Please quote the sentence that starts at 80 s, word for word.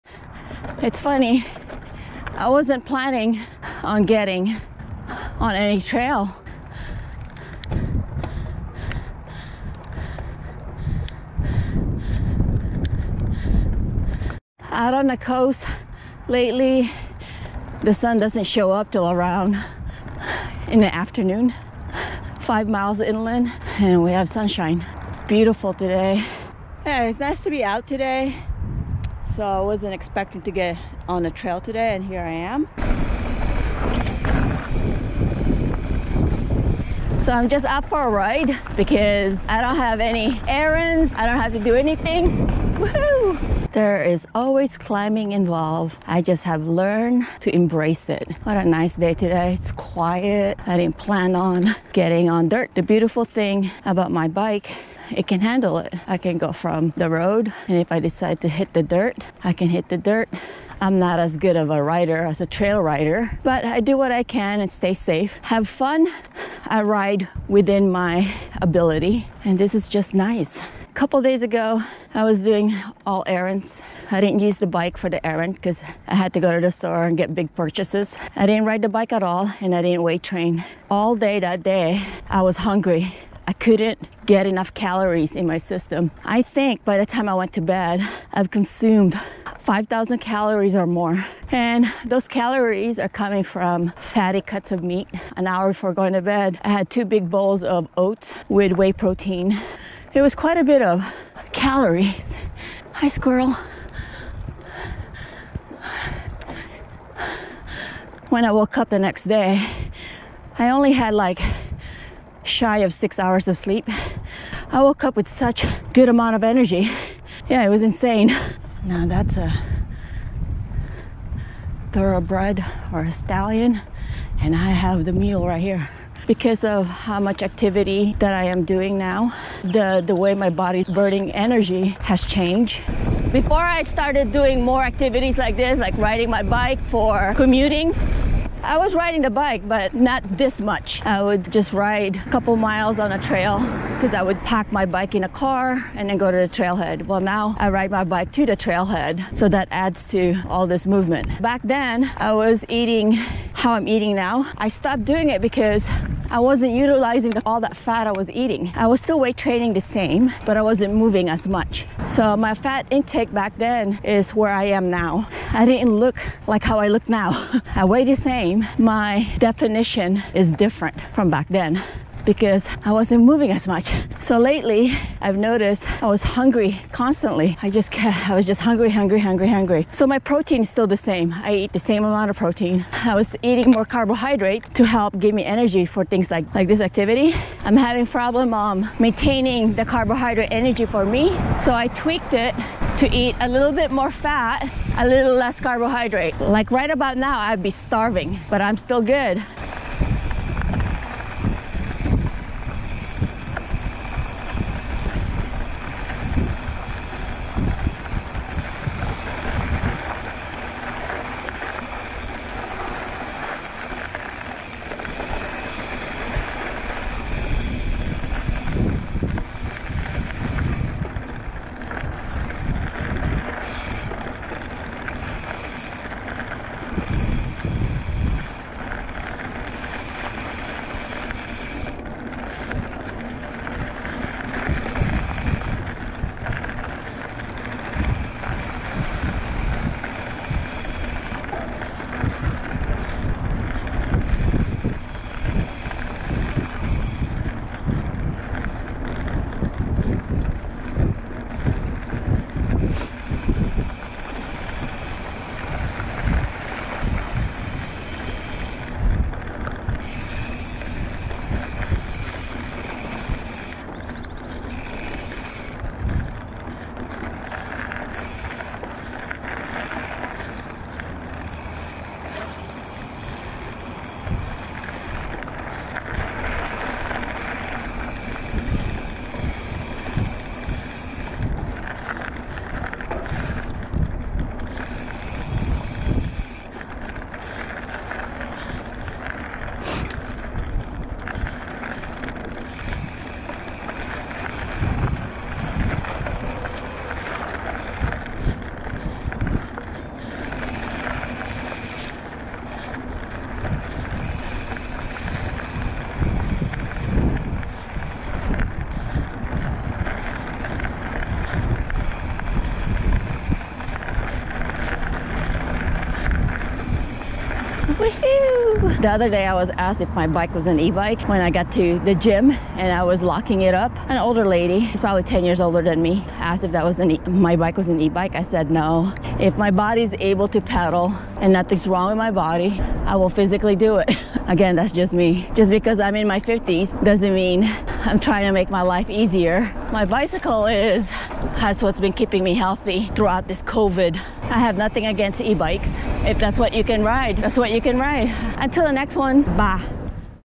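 All day that day, I was hungry I couldn't get enough calories in my system.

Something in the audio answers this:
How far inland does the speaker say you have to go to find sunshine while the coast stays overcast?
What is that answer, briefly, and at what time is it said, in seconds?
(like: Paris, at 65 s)
5 miles, at 22 s.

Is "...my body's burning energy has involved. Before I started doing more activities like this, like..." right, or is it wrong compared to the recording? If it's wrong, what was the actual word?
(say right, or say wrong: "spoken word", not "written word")
wrong: "changed", not "involved".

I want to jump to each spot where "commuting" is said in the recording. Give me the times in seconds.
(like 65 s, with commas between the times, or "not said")
137 s.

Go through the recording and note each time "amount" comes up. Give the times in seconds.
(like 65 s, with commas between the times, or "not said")
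116 s, 182 s.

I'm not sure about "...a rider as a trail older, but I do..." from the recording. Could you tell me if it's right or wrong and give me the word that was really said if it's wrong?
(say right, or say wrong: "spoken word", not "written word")
wrong: "rider", not "older".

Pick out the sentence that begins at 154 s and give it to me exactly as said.
I stopped doing it because I wasn't utilizing all that fat I was eating.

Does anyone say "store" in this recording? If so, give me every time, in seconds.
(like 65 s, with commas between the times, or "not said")
76 s.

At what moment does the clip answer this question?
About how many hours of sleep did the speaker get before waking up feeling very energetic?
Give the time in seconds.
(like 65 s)
112 s.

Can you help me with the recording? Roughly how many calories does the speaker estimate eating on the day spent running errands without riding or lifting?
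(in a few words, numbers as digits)
5,000.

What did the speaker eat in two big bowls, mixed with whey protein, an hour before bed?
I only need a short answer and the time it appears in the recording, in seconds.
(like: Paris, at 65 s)
Oats, at 97 s.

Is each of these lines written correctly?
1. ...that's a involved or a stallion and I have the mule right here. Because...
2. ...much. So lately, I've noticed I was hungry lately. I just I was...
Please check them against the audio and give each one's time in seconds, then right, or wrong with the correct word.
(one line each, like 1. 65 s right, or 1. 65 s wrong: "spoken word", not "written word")
1. 119 s wrong: "thoroughbred", not "involved"
2. 173 s wrong: "constantly", not "lately".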